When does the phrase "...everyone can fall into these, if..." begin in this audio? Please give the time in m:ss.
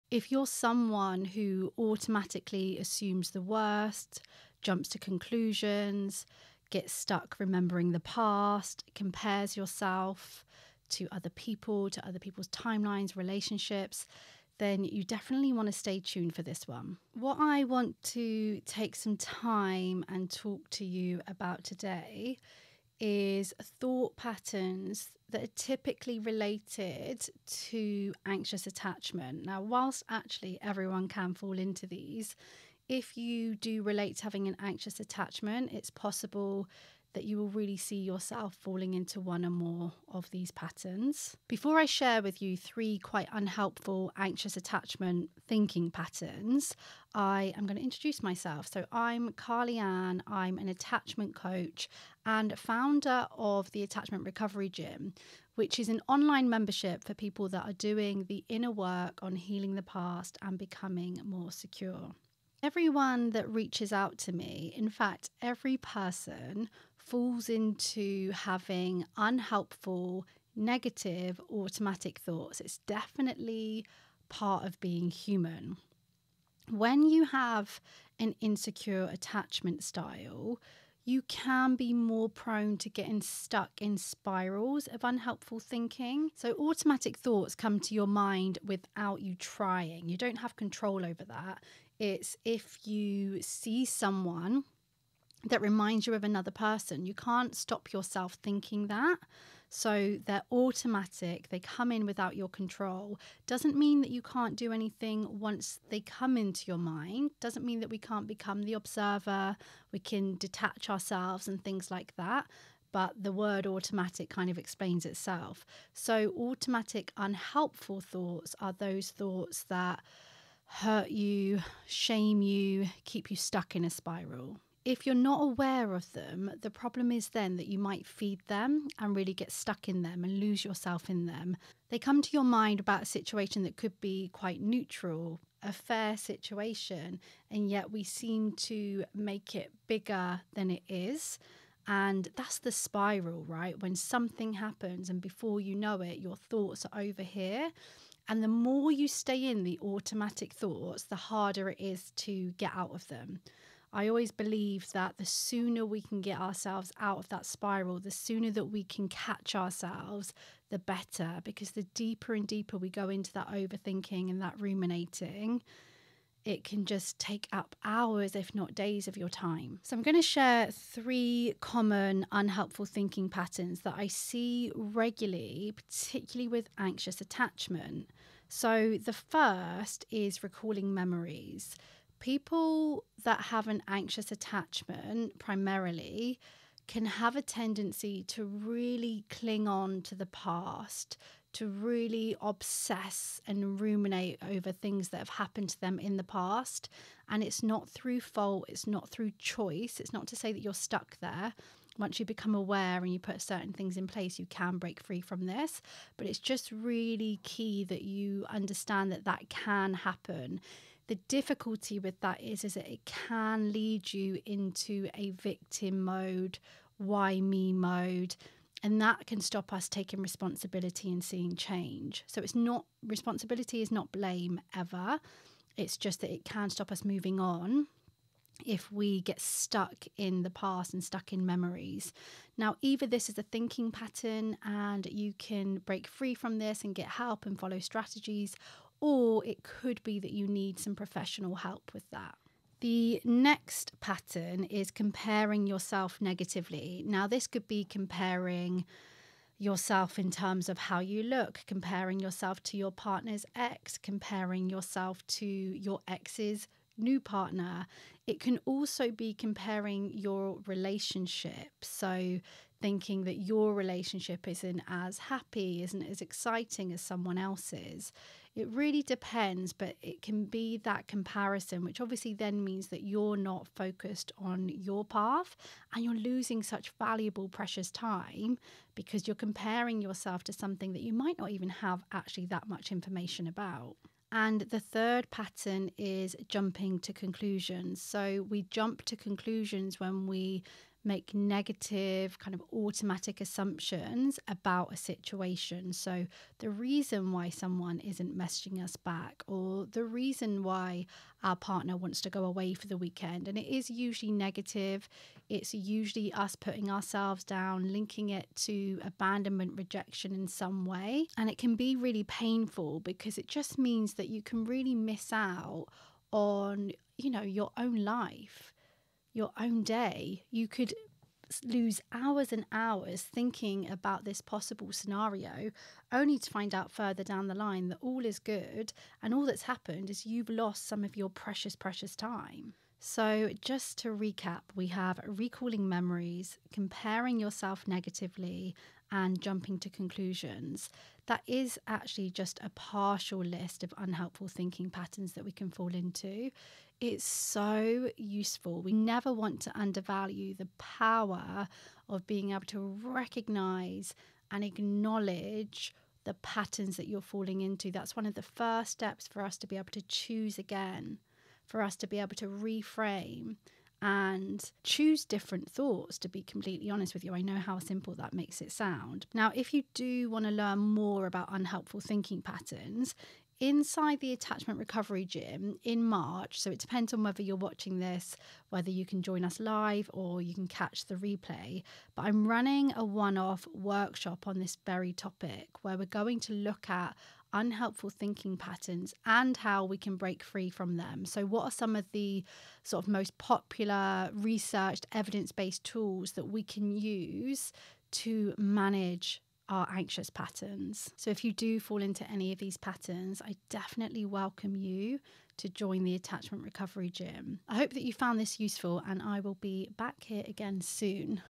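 0:30.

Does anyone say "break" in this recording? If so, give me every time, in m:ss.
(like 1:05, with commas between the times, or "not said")
3:24, 3:55, 6:30.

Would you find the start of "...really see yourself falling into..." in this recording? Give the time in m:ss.
0:37.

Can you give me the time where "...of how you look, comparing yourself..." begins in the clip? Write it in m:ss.
4:10.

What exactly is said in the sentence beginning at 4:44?
And the third pattern is jumping to conclusions.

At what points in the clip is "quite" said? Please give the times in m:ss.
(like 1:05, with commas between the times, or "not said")
0:42, 2:14.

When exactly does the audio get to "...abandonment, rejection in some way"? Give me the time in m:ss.
5:09.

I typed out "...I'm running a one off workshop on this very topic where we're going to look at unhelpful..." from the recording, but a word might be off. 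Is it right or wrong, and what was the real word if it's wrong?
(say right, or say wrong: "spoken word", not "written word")
right.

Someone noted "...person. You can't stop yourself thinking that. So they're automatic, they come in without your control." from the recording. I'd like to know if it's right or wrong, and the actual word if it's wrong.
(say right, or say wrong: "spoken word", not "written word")
right.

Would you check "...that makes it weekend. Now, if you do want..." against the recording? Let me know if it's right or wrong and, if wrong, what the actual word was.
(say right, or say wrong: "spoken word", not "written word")
wrong: "sound", not "weekend".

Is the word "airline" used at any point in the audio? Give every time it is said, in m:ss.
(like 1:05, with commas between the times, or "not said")
not said.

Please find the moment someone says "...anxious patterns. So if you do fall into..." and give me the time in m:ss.
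6:39.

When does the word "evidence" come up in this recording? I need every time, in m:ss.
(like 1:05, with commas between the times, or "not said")
6:35.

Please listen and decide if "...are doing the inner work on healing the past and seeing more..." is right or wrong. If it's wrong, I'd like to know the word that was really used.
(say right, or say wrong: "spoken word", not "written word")
wrong: "becoming", not "seeing".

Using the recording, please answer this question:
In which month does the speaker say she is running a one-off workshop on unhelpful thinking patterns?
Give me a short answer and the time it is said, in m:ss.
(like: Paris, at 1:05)
March, at 6:16.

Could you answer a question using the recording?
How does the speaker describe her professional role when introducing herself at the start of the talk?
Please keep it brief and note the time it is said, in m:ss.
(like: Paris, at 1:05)
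Attachment coach, at 0:50.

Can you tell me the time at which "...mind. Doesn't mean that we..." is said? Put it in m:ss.
1:46.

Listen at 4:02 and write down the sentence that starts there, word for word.
The next pattern is comparing yourself negatively.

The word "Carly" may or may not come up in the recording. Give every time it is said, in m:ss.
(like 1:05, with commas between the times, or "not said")
0:49.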